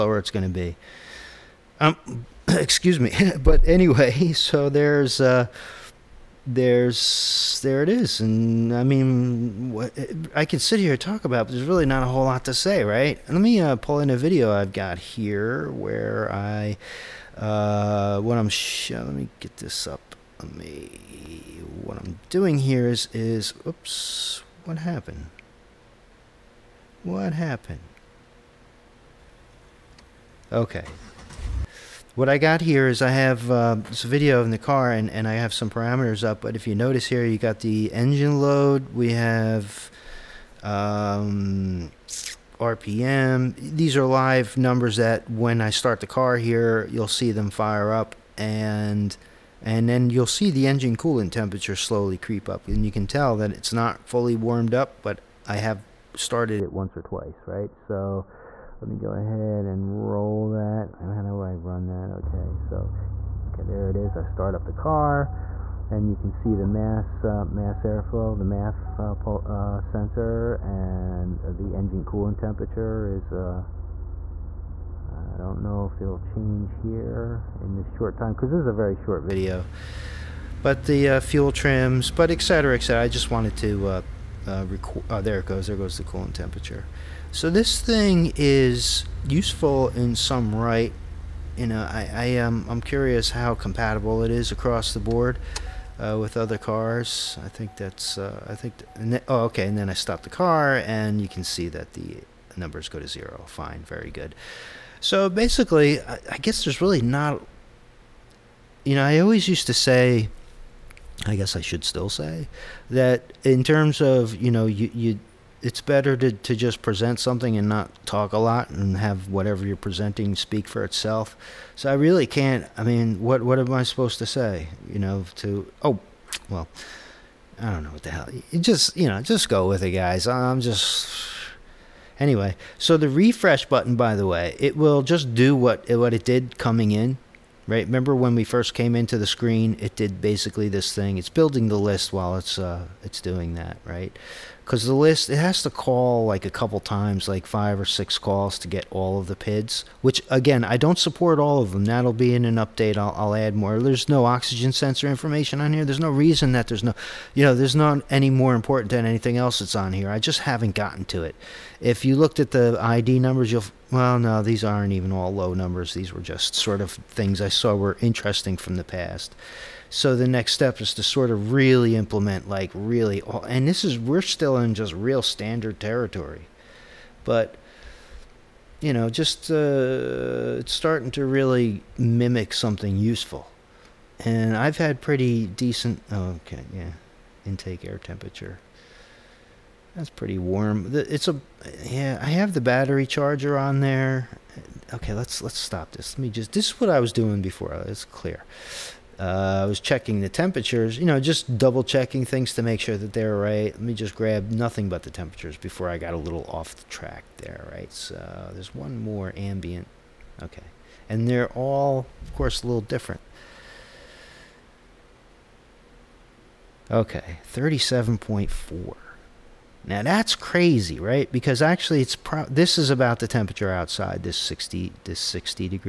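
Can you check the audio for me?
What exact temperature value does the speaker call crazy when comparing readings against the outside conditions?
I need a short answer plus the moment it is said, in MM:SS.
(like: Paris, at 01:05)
37.4, at 03:37.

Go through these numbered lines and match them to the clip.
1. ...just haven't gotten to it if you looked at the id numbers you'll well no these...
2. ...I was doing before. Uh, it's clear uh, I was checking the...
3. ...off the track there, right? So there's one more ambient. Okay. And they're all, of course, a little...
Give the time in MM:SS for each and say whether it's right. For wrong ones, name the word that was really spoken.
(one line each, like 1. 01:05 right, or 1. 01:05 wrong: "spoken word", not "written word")
1. 02:40 right
2. 03:16 right
3. 03:26 right.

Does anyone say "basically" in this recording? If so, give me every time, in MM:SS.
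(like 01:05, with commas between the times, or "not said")
01:45, 02:20.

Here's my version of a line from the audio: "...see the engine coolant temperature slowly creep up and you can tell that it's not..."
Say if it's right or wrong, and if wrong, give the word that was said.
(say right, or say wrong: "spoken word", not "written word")
right.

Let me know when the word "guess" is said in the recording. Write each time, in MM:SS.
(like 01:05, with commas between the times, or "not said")
01:46, 01:51.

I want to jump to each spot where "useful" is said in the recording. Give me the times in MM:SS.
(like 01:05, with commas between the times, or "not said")
01:29, 03:02.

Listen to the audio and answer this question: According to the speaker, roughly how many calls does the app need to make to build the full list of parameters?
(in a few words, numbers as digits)
5 or 6.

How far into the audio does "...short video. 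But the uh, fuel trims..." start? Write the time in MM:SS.
01:18.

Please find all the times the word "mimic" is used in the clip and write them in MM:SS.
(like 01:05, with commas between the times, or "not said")
03:01.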